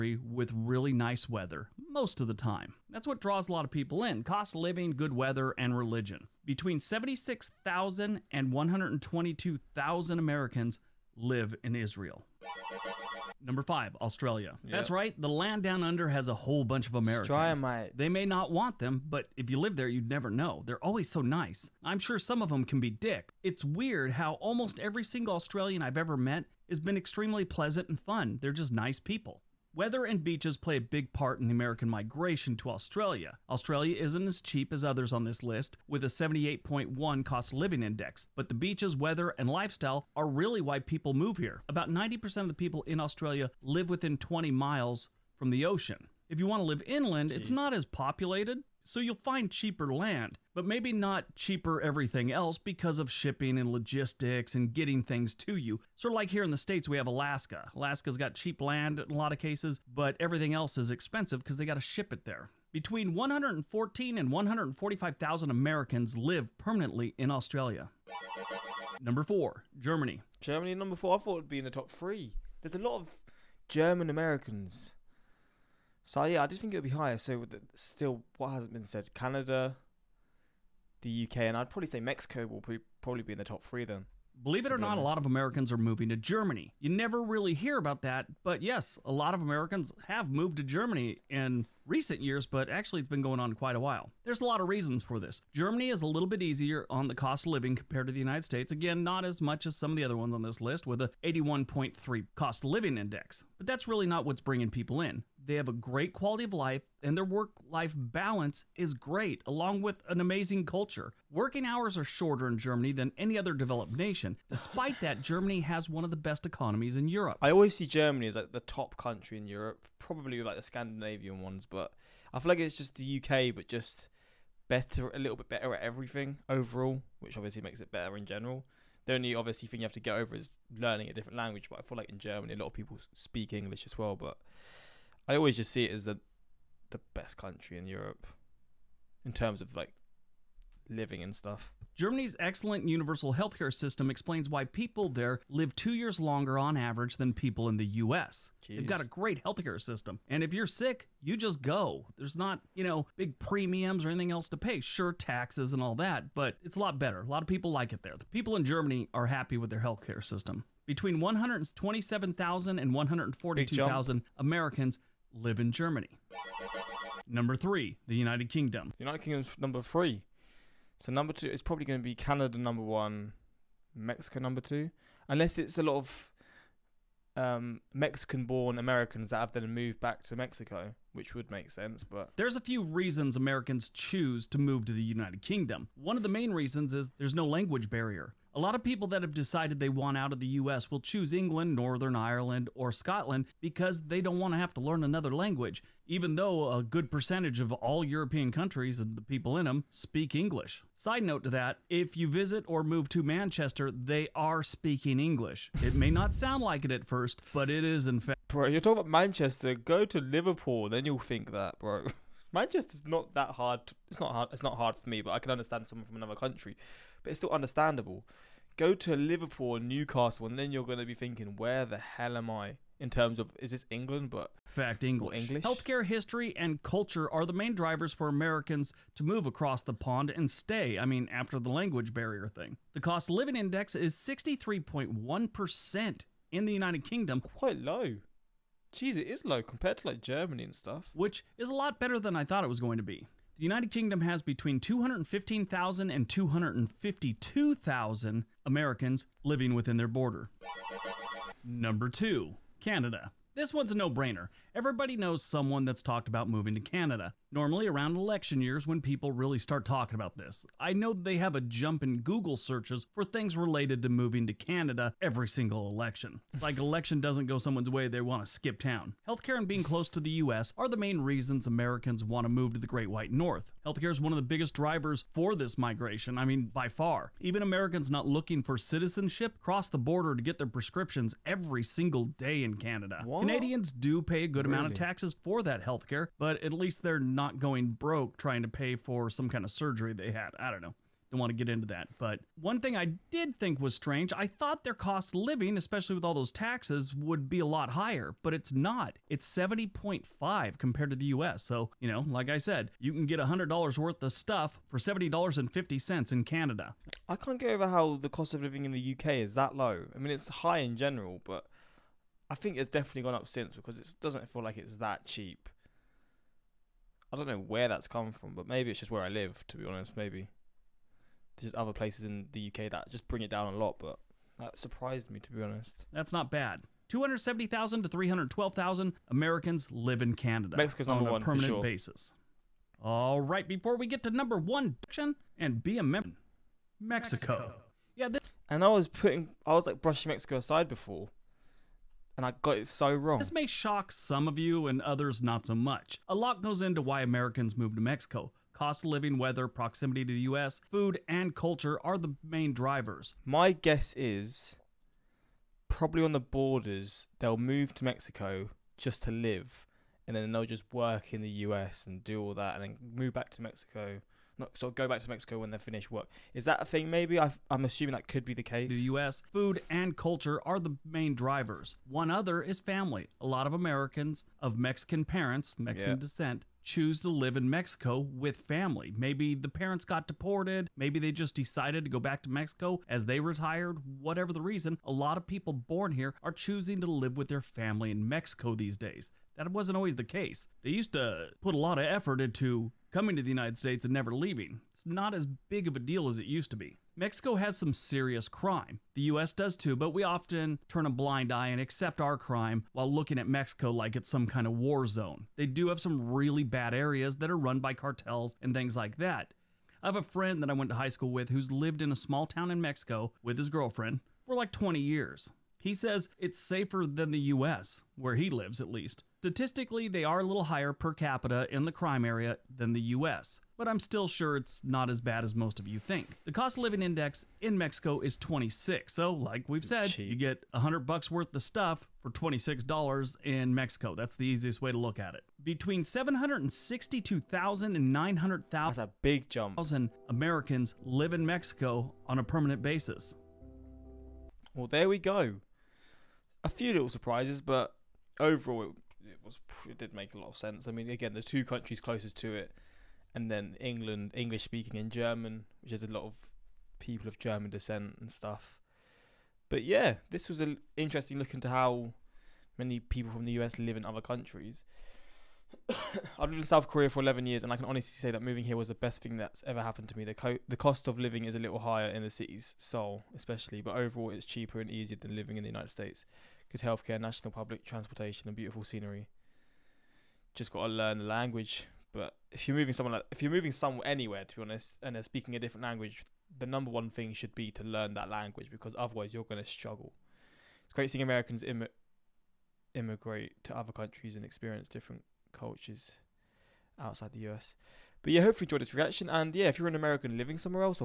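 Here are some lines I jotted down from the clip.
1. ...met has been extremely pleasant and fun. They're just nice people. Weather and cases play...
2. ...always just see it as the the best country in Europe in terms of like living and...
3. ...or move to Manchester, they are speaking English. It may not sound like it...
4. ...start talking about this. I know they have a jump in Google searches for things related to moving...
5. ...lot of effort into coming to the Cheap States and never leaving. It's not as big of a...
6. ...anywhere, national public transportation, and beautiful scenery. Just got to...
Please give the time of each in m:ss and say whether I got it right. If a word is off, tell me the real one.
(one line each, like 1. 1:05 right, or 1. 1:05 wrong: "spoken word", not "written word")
1. 0:26 wrong: "beaches", not "cases"
2. 2:15 right
3. 3:22 right
4. 4:19 right
5. 6:31 wrong: "United", not "Cheap"
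6. 7:56 wrong: "healthcare", not "anywhere".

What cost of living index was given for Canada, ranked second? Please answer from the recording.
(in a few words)
70.5.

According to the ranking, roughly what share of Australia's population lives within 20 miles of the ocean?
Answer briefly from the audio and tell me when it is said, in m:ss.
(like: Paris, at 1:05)
90%, at 0:41.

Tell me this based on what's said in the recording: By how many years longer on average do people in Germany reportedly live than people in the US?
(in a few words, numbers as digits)
2 years.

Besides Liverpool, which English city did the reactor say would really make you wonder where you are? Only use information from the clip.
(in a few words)
Newcastle.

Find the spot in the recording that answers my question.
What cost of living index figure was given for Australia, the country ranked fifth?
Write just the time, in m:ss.
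0:36.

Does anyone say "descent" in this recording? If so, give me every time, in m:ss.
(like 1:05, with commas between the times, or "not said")
6:16, 7:37.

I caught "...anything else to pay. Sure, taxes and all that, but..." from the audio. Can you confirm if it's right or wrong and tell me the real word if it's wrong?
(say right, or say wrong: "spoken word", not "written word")
right.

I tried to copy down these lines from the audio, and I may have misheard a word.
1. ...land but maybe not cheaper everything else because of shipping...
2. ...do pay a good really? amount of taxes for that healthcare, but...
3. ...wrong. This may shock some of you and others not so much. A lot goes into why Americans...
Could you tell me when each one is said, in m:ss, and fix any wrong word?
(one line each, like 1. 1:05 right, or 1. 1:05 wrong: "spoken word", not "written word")
1. 0:49 right
2. 4:43 right
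3. 5:43 right.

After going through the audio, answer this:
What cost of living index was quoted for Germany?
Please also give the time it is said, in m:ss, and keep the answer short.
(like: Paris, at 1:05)
81.3, at 1:41.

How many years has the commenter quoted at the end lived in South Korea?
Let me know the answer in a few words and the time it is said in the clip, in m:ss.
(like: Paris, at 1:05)
11 years, at 7:47.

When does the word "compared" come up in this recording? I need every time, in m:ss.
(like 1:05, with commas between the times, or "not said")
1:37, 3:59, 5:00.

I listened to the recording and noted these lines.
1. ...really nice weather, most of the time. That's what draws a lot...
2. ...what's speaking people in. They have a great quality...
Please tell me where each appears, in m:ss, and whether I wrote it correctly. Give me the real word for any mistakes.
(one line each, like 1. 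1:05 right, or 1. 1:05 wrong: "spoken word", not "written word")
1. 0:00 right
2. 1:44 wrong: "bringing", not "speaking".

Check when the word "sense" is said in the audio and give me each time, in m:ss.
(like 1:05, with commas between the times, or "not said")
3:01, 7:30.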